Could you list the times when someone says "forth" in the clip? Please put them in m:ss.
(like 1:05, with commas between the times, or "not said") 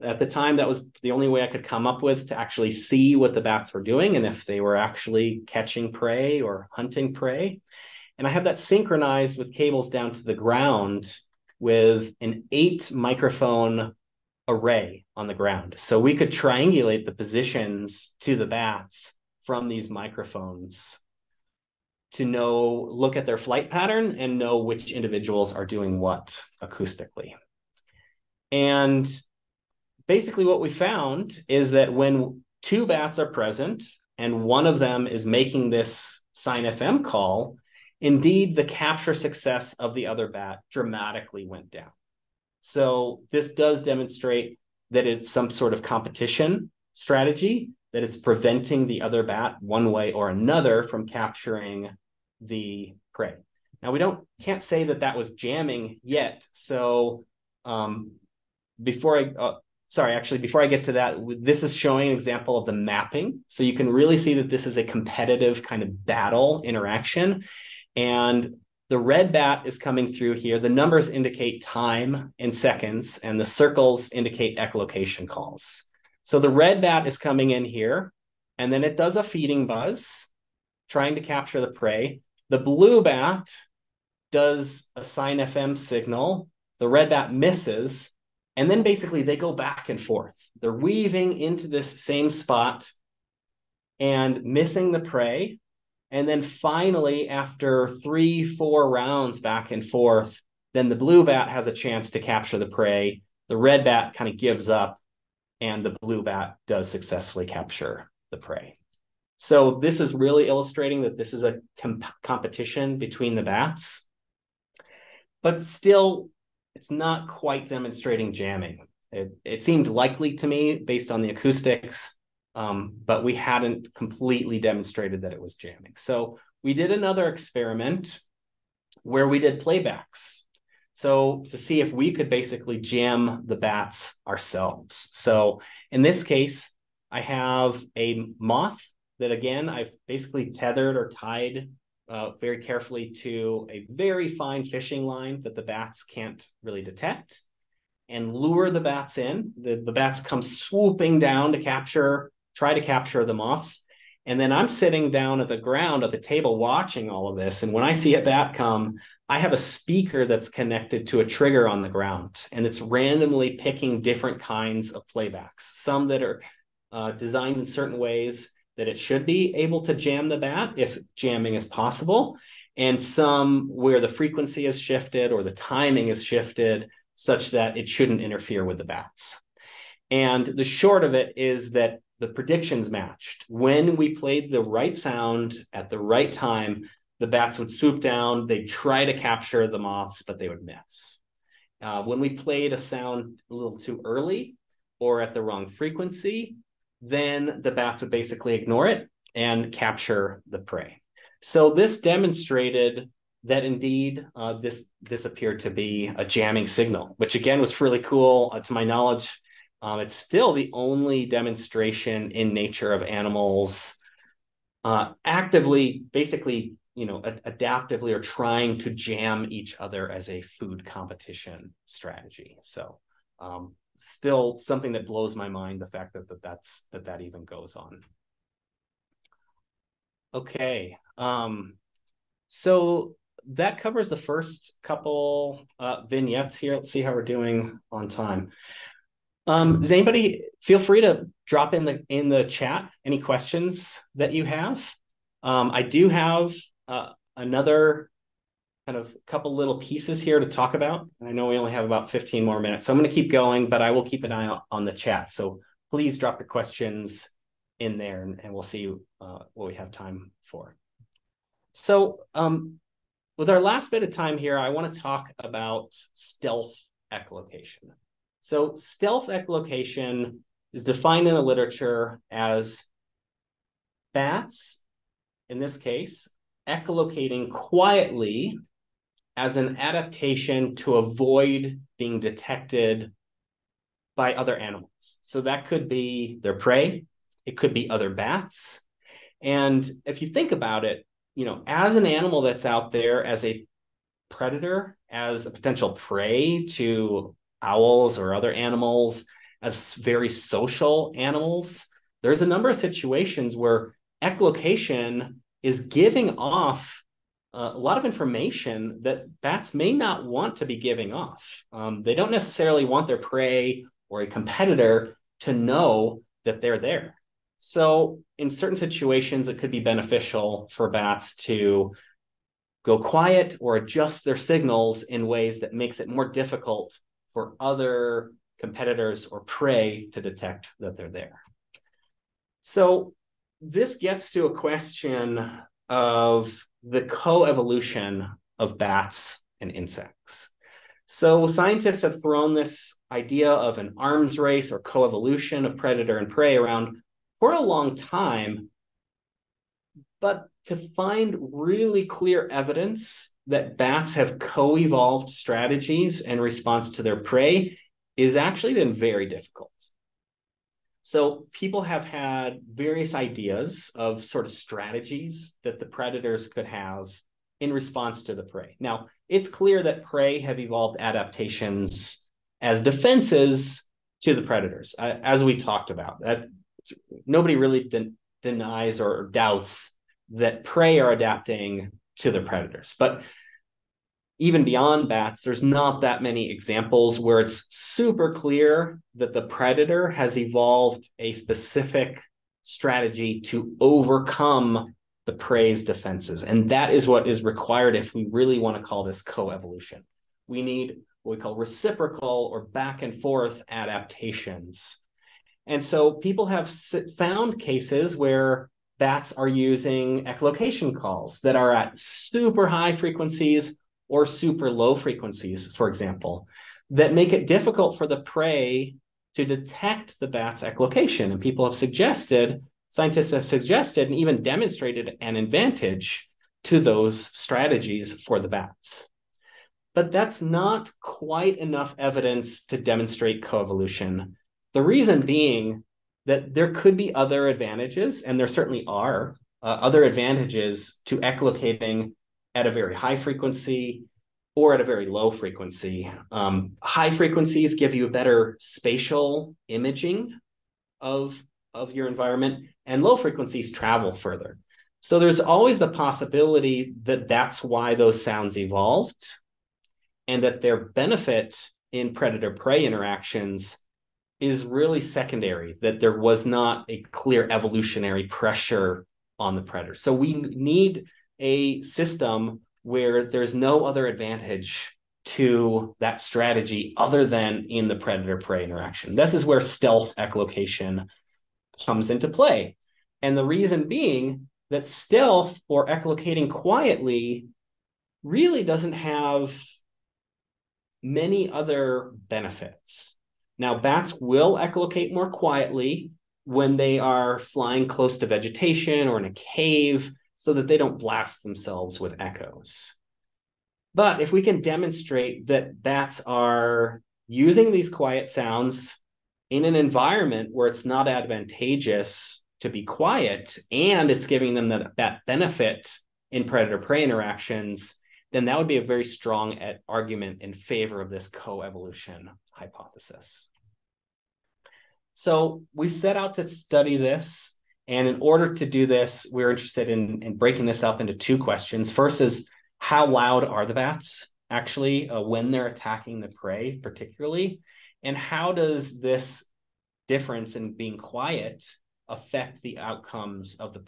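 1:29, 1:39, 6:43.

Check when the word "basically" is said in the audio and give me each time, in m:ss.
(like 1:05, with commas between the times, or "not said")
0:30, 1:28, 2:12, 2:20, 3:18, 3:36.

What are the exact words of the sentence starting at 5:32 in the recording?
So, this gets to a question of the co-evolution of bats and insects.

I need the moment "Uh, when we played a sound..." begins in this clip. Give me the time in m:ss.
3:11.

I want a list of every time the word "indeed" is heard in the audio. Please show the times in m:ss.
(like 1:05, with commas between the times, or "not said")
0:37, 3:23.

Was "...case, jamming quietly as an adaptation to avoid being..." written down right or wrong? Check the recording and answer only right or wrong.
wrong.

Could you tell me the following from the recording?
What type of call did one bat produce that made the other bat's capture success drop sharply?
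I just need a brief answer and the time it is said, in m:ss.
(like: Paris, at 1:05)
sine FM call, at 0:36.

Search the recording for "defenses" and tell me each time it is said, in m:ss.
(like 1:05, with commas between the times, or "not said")
6:12, 6:35.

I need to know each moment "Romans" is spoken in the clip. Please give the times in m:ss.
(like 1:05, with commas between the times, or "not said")
not said.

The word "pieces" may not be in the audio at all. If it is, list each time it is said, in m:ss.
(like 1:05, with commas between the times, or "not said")
4:09.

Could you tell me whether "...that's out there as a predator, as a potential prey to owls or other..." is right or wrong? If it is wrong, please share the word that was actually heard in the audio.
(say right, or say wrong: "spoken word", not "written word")
right.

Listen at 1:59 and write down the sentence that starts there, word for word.
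It, it seemed likely to me based on the acoustics, um, but we hadn't completely demonstrated that it was jamming.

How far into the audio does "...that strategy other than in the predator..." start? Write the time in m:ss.
7:55.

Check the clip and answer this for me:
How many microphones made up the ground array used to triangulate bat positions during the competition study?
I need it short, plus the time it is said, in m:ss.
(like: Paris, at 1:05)
8, at 0:12.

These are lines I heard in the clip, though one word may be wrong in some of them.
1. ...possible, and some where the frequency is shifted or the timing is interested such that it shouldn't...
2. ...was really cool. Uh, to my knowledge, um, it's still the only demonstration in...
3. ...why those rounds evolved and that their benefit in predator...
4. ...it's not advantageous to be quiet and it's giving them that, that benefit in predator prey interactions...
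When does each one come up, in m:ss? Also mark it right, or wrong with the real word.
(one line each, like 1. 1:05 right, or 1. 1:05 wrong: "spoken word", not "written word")
1. 2:51 wrong: "shifted", not "interested"
2. 3:27 right
3. 7:37 wrong: "sounds", not "rounds"
4. 8:30 right.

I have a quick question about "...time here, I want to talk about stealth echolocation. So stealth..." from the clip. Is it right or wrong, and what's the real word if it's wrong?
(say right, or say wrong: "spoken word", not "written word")
right.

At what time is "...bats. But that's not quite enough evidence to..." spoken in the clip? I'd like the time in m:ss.
7:08.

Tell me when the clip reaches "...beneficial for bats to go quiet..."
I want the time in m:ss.
5:19.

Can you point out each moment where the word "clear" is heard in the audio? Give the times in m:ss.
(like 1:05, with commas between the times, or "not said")
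5:52, 6:09, 6:28, 7:47.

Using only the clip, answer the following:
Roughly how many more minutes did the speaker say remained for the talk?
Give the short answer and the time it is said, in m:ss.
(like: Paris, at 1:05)
15, at 4:12.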